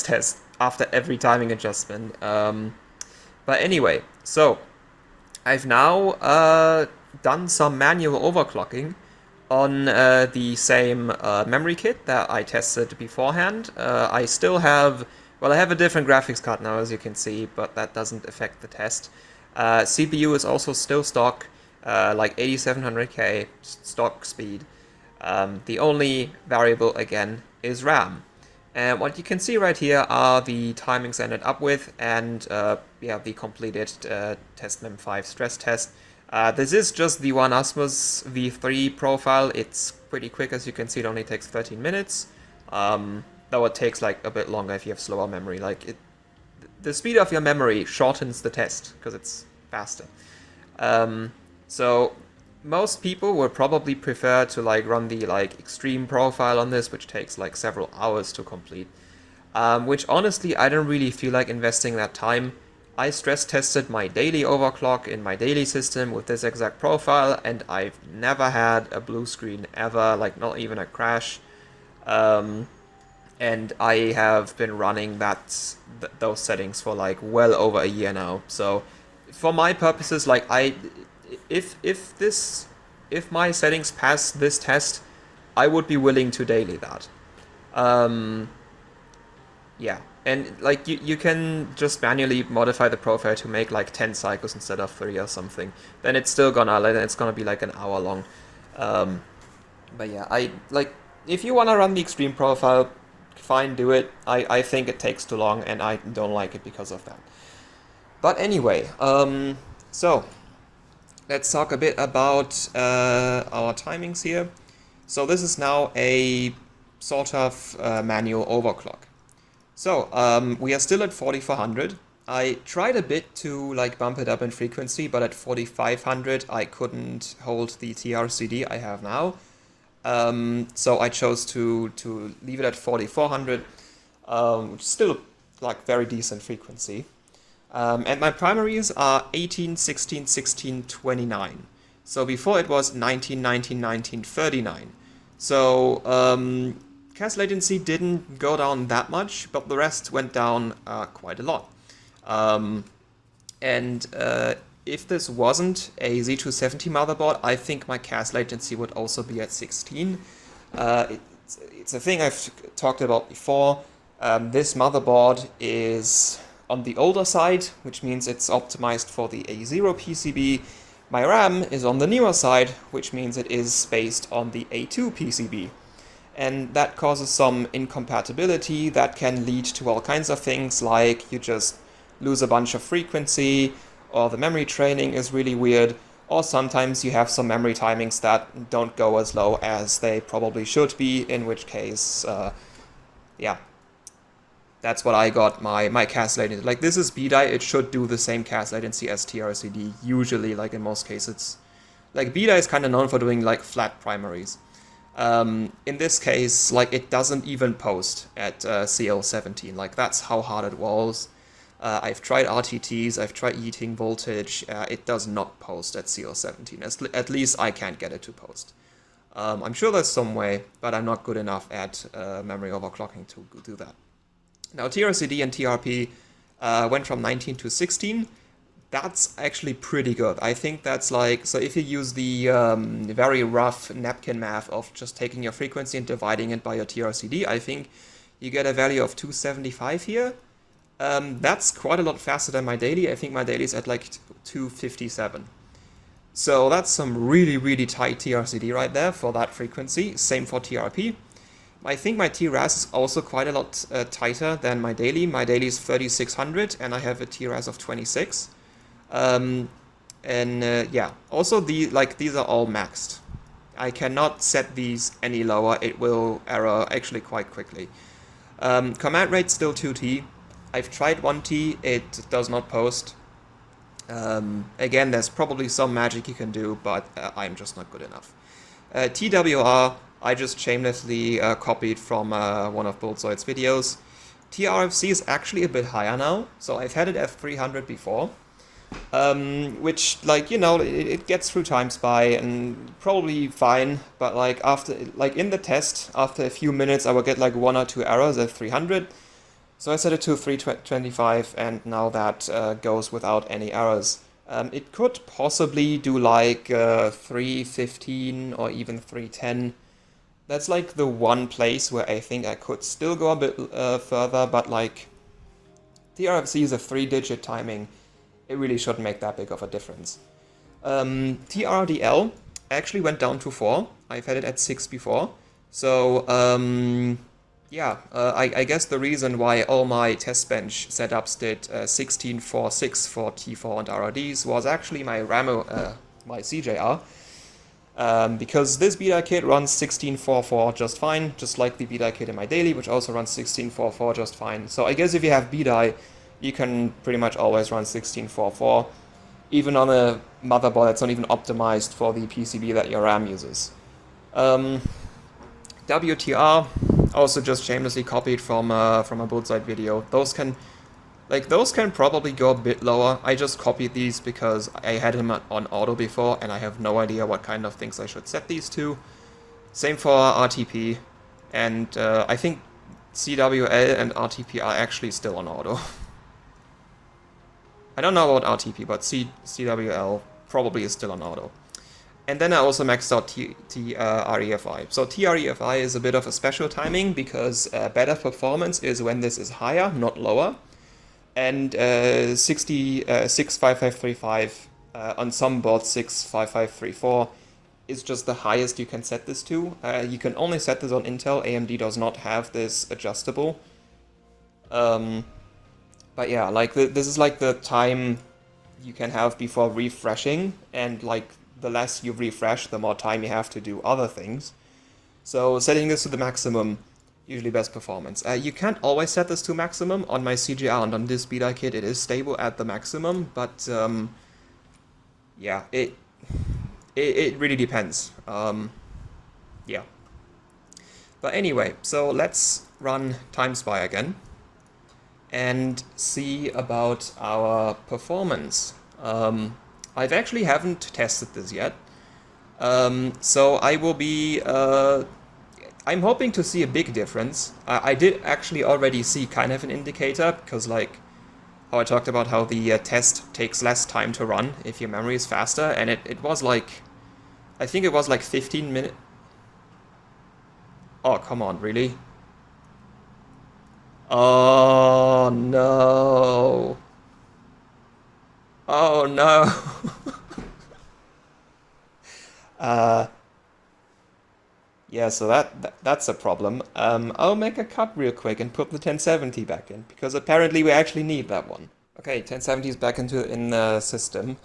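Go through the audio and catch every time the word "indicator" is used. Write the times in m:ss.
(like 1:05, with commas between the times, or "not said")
7:29.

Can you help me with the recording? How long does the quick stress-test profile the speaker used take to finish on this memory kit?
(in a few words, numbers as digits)
13 minutes.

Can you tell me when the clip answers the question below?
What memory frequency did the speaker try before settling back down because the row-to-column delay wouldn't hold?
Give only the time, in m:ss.
2:05.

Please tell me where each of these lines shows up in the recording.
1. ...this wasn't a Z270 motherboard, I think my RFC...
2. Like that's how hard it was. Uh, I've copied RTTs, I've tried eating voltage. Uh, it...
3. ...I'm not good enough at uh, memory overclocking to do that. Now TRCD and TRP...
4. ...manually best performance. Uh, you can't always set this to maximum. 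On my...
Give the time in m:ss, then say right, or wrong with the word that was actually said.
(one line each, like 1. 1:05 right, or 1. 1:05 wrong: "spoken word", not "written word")
1. 2:35 wrong: "CAS", not "RFC"
2. 3:29 wrong: "tried", not "copied"
3. 3:40 right
4. 6:57 wrong: "usually", not "manually".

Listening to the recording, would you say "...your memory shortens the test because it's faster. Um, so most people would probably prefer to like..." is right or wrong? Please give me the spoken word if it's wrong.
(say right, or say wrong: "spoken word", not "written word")
right.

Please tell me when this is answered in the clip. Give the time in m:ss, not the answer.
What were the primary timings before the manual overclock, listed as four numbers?
2:22.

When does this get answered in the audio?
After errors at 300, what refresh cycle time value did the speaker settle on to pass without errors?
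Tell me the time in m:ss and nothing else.
5:00.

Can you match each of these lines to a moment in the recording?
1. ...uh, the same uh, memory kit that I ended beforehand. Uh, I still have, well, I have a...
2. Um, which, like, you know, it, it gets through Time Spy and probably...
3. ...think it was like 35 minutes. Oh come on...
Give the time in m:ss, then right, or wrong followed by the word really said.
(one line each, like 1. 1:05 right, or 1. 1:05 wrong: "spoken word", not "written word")
1. 0:09 wrong: "tested", not "ended"
2. 4:49 right
3. 7:37 wrong: "15", not "35".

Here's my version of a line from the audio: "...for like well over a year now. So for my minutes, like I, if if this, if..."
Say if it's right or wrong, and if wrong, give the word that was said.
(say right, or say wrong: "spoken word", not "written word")
wrong: "purposes", not "minutes".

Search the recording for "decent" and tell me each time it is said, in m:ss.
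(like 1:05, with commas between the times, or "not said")
2:16.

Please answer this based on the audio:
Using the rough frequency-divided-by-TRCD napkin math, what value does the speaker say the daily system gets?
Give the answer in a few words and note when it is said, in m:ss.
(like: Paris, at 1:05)
257, at 4:04.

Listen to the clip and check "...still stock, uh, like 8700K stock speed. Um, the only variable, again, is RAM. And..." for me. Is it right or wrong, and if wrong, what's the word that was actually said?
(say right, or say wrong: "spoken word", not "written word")
right.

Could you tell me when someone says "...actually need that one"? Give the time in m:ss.
8:00.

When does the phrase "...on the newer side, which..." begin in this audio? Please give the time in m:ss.
2:51.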